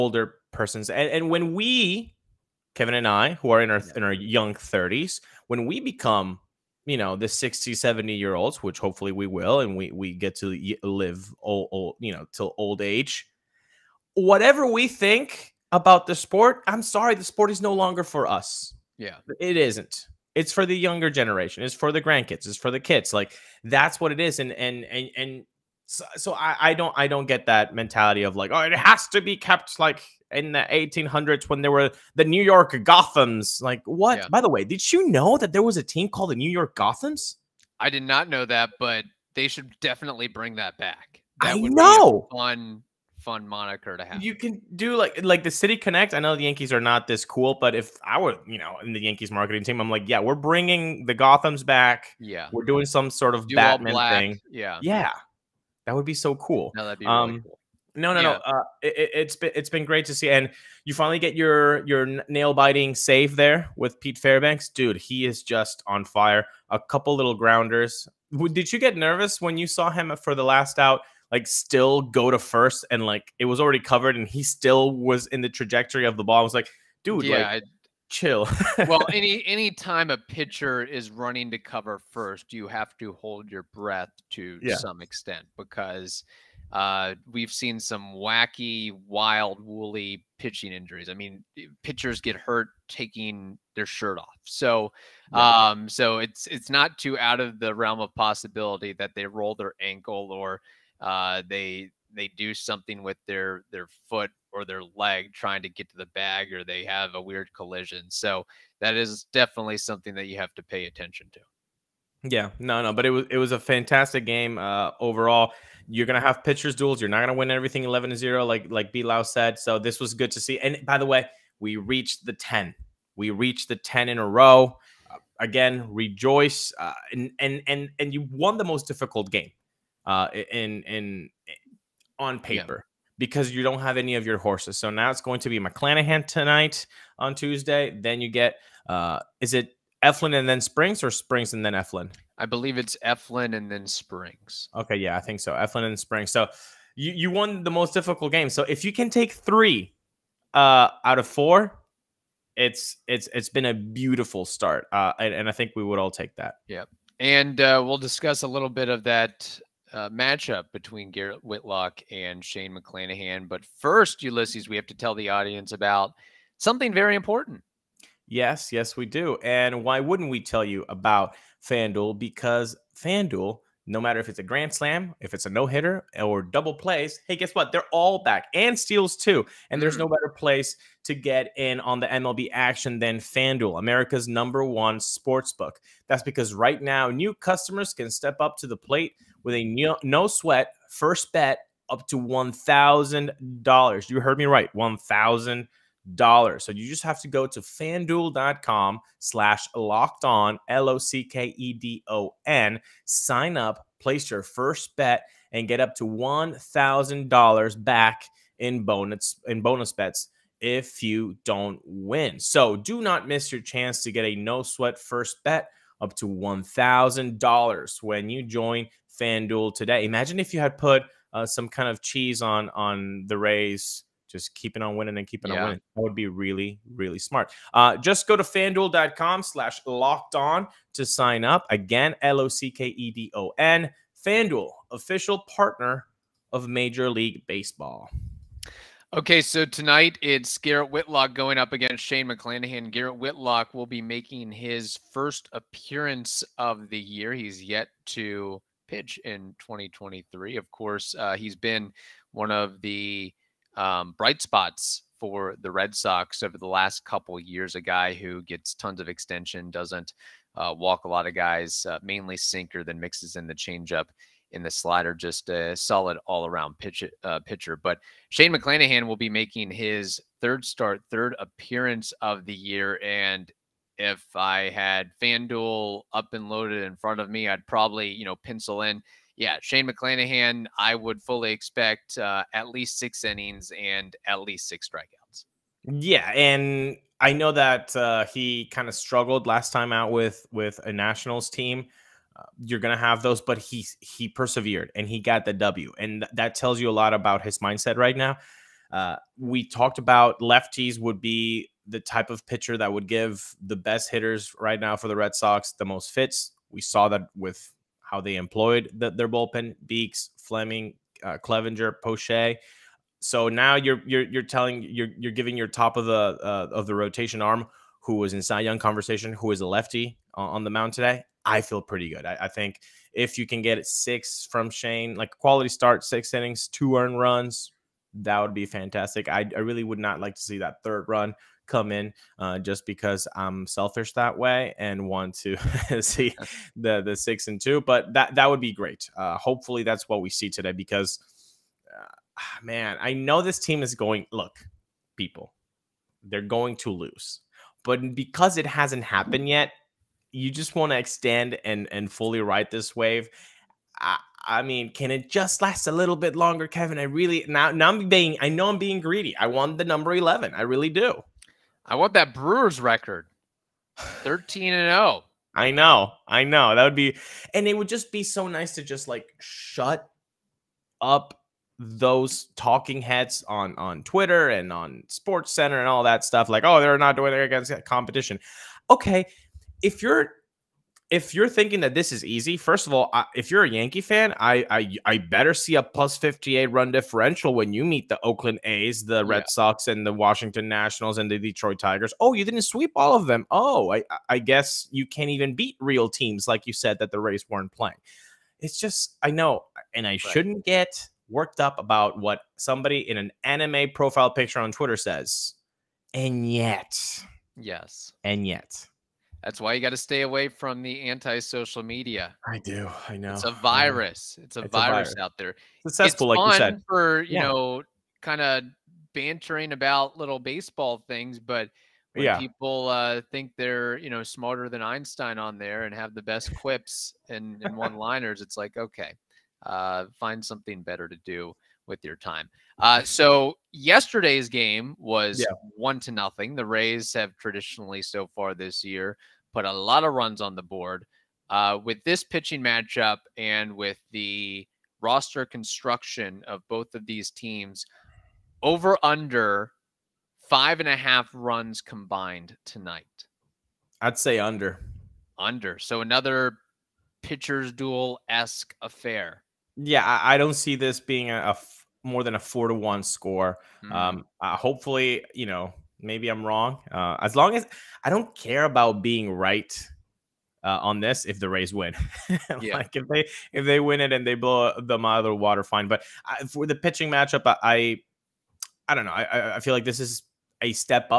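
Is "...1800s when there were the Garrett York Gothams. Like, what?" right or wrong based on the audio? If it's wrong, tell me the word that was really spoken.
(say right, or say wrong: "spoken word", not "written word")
wrong: "New", not "Garrett".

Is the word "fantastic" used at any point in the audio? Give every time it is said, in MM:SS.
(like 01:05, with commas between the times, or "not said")
01:53, 05:28.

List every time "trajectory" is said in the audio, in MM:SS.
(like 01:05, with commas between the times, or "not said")
01:15.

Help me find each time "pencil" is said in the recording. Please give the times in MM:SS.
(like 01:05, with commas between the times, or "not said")
04:38.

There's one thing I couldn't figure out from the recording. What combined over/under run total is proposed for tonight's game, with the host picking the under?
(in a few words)
5.5 runs.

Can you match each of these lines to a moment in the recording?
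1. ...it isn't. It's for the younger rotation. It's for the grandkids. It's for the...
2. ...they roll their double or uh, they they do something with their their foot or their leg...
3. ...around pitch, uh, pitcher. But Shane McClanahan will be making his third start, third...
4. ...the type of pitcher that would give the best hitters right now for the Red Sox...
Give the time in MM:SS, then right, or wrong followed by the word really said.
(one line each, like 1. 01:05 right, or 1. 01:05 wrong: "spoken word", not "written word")
1. 00:19 wrong: "generation", not "rotation"
2. 01:39 wrong: "ankle", not "double"
3. 04:26 right
4. 05:01 right.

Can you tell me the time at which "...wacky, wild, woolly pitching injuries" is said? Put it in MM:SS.
01:28.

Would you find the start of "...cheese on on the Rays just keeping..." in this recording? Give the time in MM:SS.
03:42.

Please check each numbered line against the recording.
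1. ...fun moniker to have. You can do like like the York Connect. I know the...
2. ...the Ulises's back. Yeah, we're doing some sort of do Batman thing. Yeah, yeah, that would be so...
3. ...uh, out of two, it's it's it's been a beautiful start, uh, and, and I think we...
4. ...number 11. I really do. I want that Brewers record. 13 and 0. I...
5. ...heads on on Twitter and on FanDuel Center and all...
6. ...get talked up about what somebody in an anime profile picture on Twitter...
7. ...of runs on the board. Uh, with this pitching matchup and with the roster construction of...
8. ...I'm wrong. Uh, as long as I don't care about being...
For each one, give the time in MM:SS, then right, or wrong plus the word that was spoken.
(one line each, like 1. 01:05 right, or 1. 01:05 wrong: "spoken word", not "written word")
1. 00:43 wrong: "City", not "York"
2. 00:51 wrong: "Gotham", not "Ulises"
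3. 02:30 wrong: "four", not "two"
4. 05:59 right
5. 06:13 wrong: "Sports", not "FanDuel"
6. 06:40 wrong: "worked", not "talked"
7. 07:20 right
8. 07:46 right.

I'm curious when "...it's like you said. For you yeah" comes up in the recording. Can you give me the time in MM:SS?
06:56.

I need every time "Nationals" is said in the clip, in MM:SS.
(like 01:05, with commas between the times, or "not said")
04:50, 06:30.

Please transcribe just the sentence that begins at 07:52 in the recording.
like if they if they win it and they blow them out of the water, fine.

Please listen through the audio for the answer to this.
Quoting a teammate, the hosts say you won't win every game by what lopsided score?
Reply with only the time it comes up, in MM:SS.
01:57.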